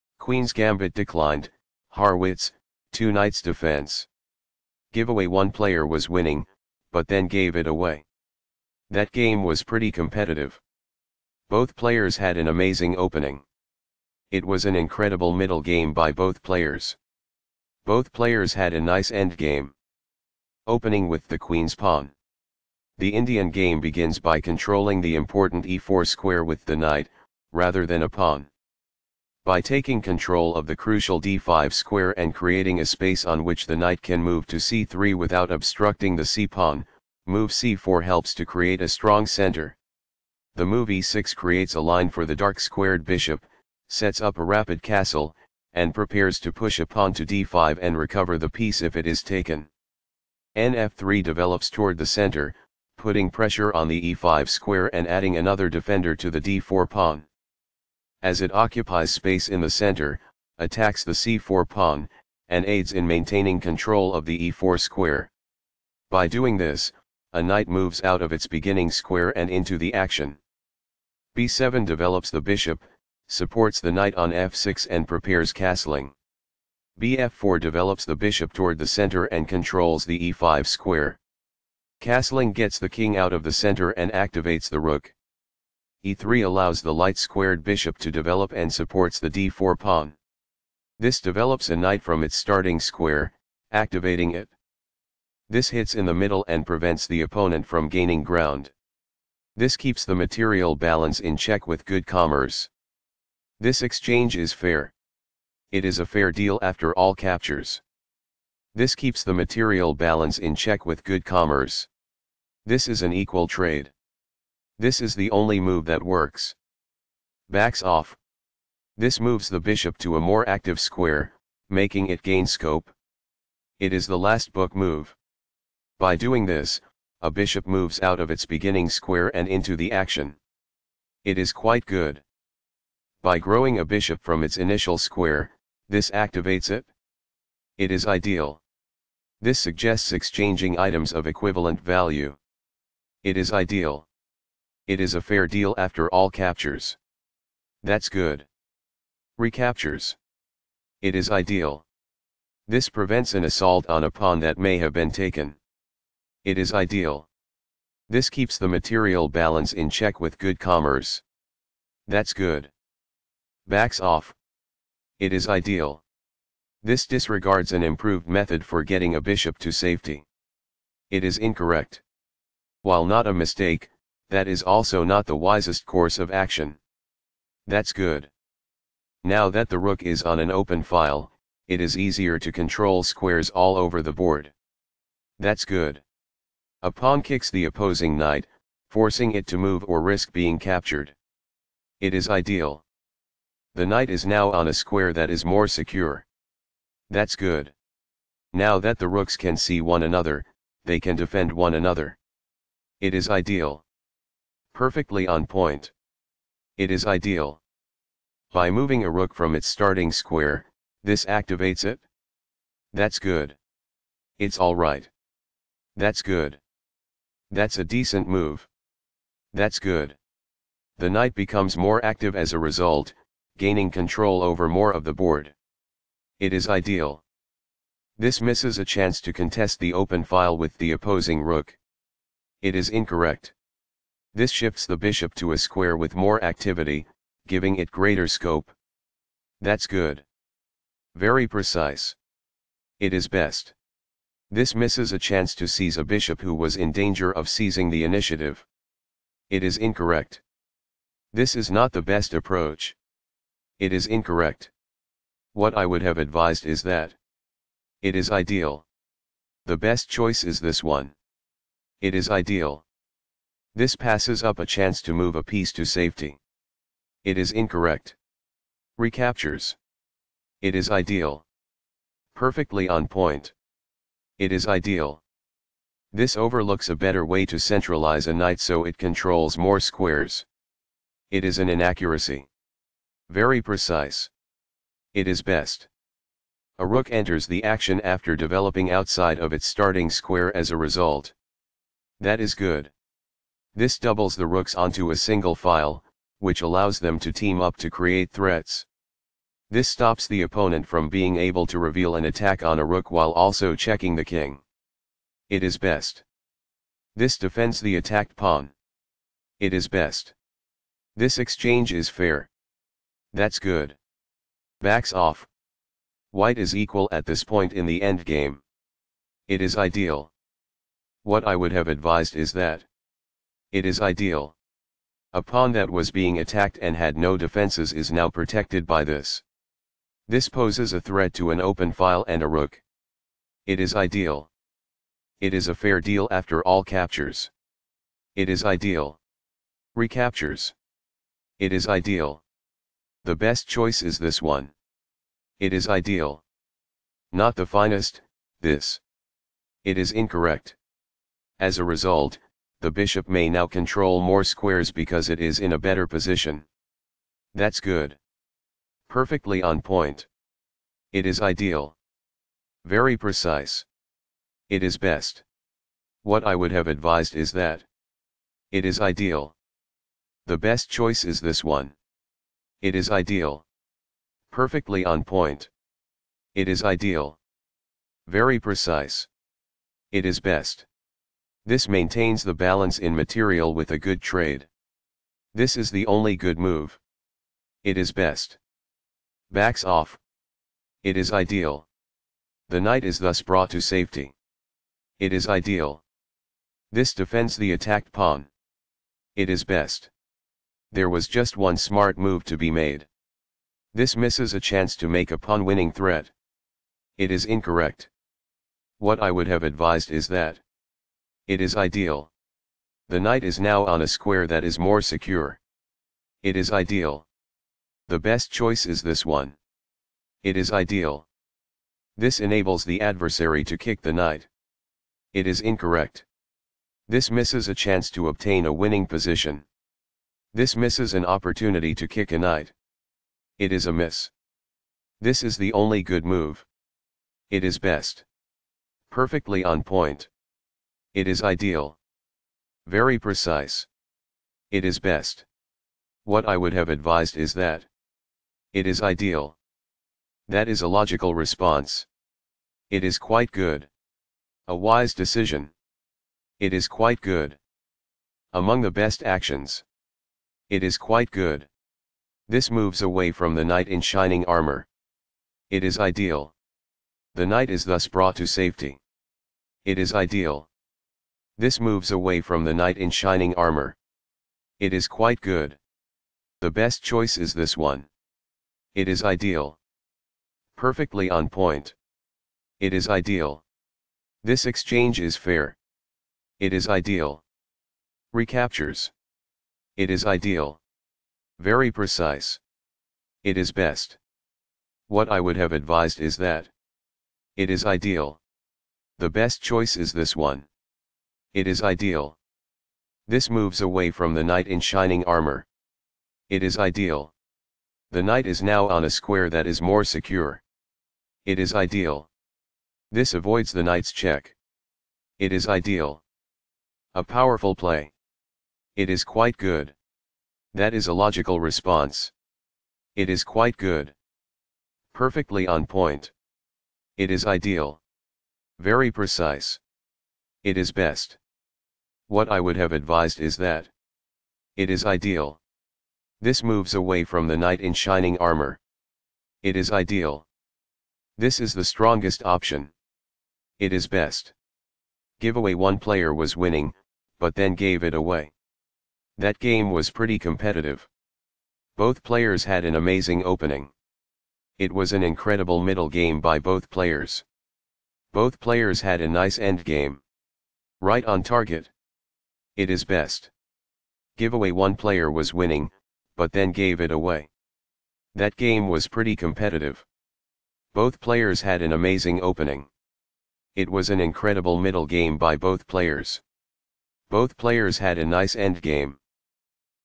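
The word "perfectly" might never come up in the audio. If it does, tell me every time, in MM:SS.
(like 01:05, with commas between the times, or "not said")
03:24, 04:32, 05:59, 06:14, 07:19, 08:00, 08:45.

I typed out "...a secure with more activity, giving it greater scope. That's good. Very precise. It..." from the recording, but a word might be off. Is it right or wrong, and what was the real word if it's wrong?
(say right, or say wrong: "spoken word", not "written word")
wrong: "square", not "secure".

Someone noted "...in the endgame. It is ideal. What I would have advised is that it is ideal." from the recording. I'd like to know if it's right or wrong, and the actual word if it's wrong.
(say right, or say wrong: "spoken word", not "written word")
right.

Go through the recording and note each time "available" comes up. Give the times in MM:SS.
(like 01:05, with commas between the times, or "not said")
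not said.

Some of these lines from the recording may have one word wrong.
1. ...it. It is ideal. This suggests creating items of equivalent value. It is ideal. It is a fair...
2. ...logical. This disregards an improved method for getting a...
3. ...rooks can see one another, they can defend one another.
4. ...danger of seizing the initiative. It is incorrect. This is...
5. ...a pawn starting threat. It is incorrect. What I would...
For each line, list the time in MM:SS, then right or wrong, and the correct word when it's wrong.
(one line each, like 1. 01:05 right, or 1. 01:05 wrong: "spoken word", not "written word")
1. 02:16 wrong: "exchanging", not "creating"
2. 02:45 wrong: "ideal", not "logical"
3. 03:19 right
4. 04:06 right
5. 06:45 wrong: "winning", not "starting".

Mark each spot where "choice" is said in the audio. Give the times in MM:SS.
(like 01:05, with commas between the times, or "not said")
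04:20, 05:43, 06:10, 06:58, 07:57, 08:19.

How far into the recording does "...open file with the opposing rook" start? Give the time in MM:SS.
03:49.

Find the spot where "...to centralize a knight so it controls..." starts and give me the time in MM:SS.
04:37.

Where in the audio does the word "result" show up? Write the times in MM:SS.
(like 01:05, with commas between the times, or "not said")
03:42, 04:50, 05:51.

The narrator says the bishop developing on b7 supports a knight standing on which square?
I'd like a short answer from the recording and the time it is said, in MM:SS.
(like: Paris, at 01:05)
f6, at 01:13.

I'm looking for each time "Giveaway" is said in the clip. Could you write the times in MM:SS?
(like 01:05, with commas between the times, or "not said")
00:04, 09:05, 09:24.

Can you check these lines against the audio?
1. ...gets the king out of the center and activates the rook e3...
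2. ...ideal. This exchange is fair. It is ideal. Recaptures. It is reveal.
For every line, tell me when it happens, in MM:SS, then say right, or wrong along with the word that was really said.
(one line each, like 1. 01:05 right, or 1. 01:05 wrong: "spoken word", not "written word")
1. 01:22 right
2. 08:03 wrong: "ideal", not "reveal".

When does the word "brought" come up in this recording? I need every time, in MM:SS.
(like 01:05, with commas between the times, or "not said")
06:33, 07:48.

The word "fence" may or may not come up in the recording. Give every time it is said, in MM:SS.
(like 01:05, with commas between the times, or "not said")
not said.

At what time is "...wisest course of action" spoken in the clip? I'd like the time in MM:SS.
02:55.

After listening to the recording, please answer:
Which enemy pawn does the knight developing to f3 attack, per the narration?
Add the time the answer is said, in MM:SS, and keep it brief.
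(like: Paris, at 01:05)
c4, at 01:00.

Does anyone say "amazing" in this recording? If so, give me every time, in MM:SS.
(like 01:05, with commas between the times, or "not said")
00:12, 09:12, 09:31.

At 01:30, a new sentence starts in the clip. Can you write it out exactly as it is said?
This develops a knight from its starting square, activating it.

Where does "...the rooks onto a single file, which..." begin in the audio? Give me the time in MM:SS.
04:54.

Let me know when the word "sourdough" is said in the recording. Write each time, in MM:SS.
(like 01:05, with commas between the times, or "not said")
not said.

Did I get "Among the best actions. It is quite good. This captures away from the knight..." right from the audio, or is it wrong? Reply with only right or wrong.
wrong.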